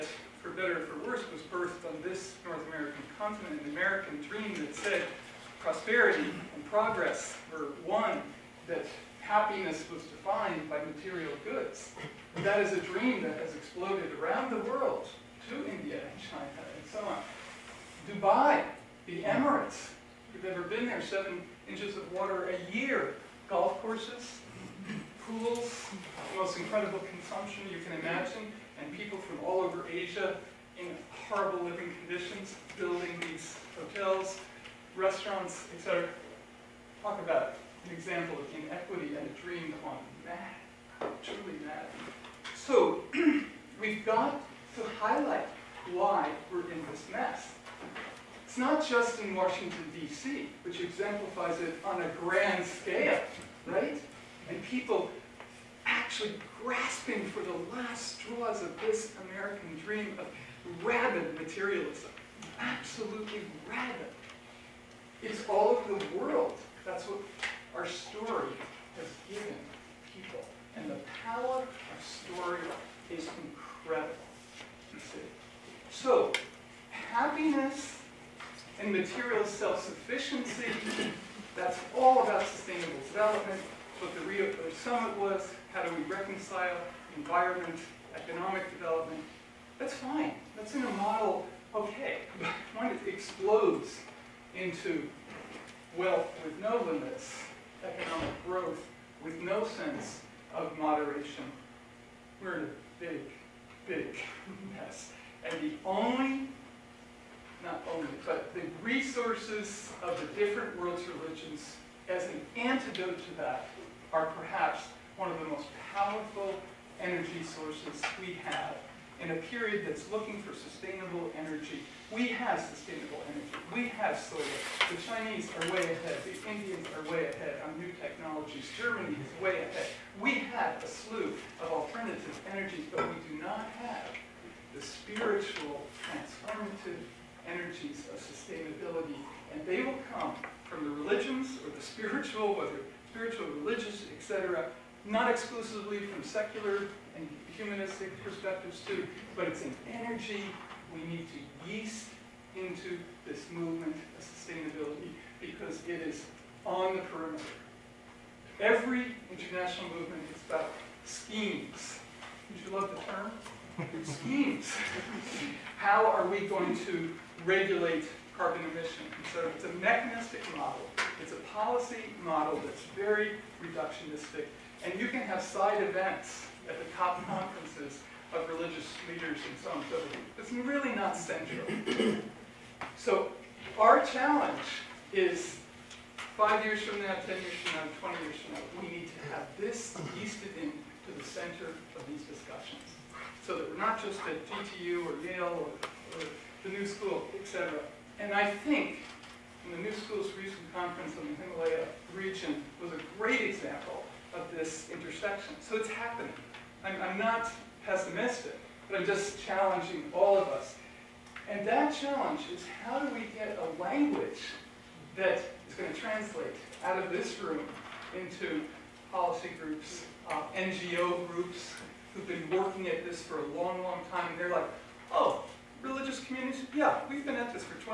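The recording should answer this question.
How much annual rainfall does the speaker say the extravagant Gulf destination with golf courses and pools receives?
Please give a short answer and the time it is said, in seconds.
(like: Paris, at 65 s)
7 inches, at 21 s.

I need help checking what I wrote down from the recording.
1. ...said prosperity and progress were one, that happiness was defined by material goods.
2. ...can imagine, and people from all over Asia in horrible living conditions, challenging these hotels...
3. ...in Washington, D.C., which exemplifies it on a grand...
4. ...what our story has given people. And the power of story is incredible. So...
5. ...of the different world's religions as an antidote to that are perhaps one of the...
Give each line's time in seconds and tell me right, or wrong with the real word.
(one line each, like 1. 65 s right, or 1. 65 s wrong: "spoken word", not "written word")
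1. 4 s right
2. 27 s wrong: "building", not "challenging"
3. 49 s right
4. 67 s right
5. 110 s right.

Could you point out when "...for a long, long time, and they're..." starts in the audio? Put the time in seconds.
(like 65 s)
223 s.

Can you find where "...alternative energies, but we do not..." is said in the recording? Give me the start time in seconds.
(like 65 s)
131 s.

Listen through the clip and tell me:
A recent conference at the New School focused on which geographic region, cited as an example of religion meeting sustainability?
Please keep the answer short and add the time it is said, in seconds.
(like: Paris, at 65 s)
Himalaya region, at 201 s.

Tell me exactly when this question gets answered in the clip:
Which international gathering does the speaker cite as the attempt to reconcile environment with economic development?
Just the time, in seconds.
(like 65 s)
84 s.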